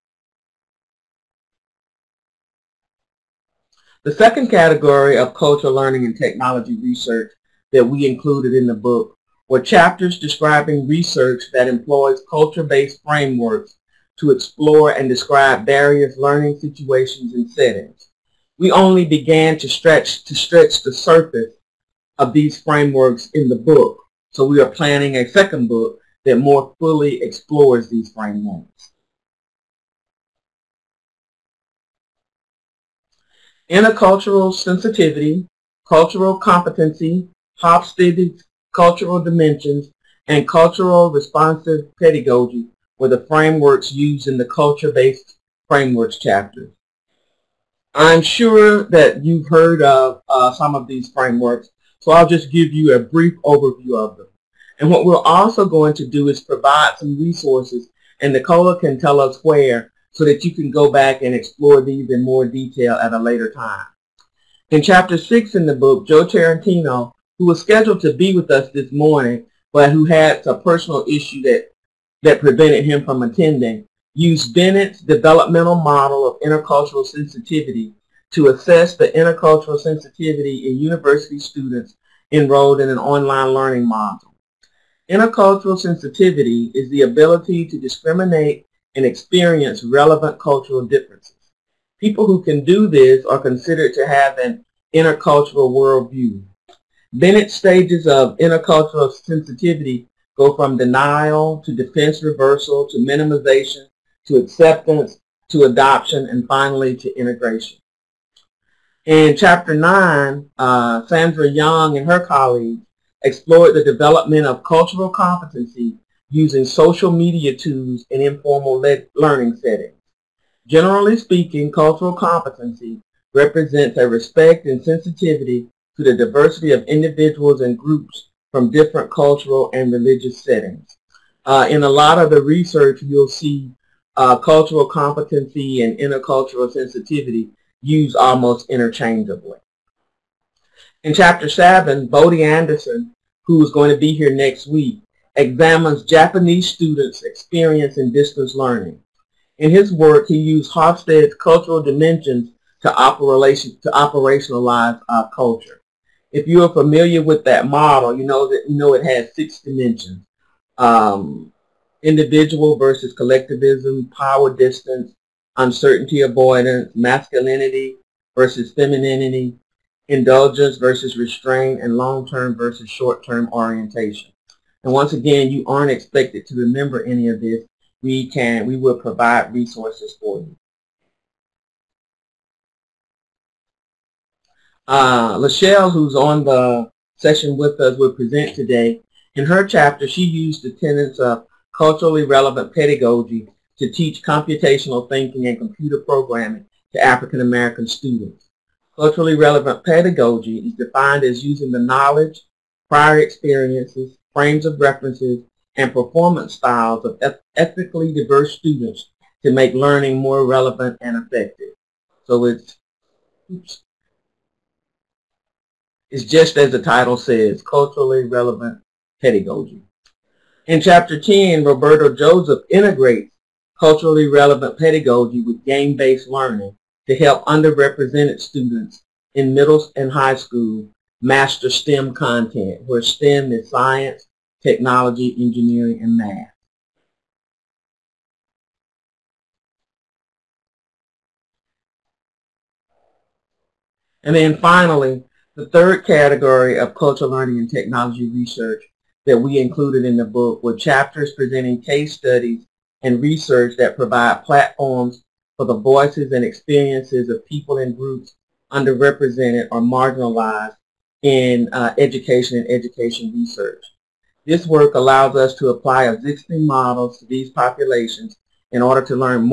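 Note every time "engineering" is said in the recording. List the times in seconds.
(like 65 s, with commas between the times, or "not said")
235 s.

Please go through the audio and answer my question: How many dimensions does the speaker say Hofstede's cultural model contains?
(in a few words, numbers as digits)
6.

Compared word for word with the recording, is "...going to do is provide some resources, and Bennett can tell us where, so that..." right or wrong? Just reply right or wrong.
wrong.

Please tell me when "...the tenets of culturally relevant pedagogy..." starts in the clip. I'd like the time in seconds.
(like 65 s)
190 s.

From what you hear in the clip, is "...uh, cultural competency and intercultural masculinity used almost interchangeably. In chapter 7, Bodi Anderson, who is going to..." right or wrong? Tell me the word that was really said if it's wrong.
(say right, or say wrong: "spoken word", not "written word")
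wrong: "sensitivity", not "masculinity".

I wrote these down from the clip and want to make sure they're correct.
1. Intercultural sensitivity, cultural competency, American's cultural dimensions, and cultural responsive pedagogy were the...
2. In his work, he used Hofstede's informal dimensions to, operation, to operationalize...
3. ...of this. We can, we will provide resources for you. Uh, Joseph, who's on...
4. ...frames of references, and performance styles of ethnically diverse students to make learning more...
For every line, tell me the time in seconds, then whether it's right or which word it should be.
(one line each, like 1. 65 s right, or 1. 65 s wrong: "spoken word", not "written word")
1. 33 s wrong: "Hofstede", not "American"
2. 149 s wrong: "cultural", not "informal"
3. 177 s wrong: "Leshell", not "Joseph"
4. 204 s right.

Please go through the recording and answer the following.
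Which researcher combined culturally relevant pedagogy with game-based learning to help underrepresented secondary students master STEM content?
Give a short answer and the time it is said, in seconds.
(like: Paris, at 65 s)
Roberto Joseph, at 221 s.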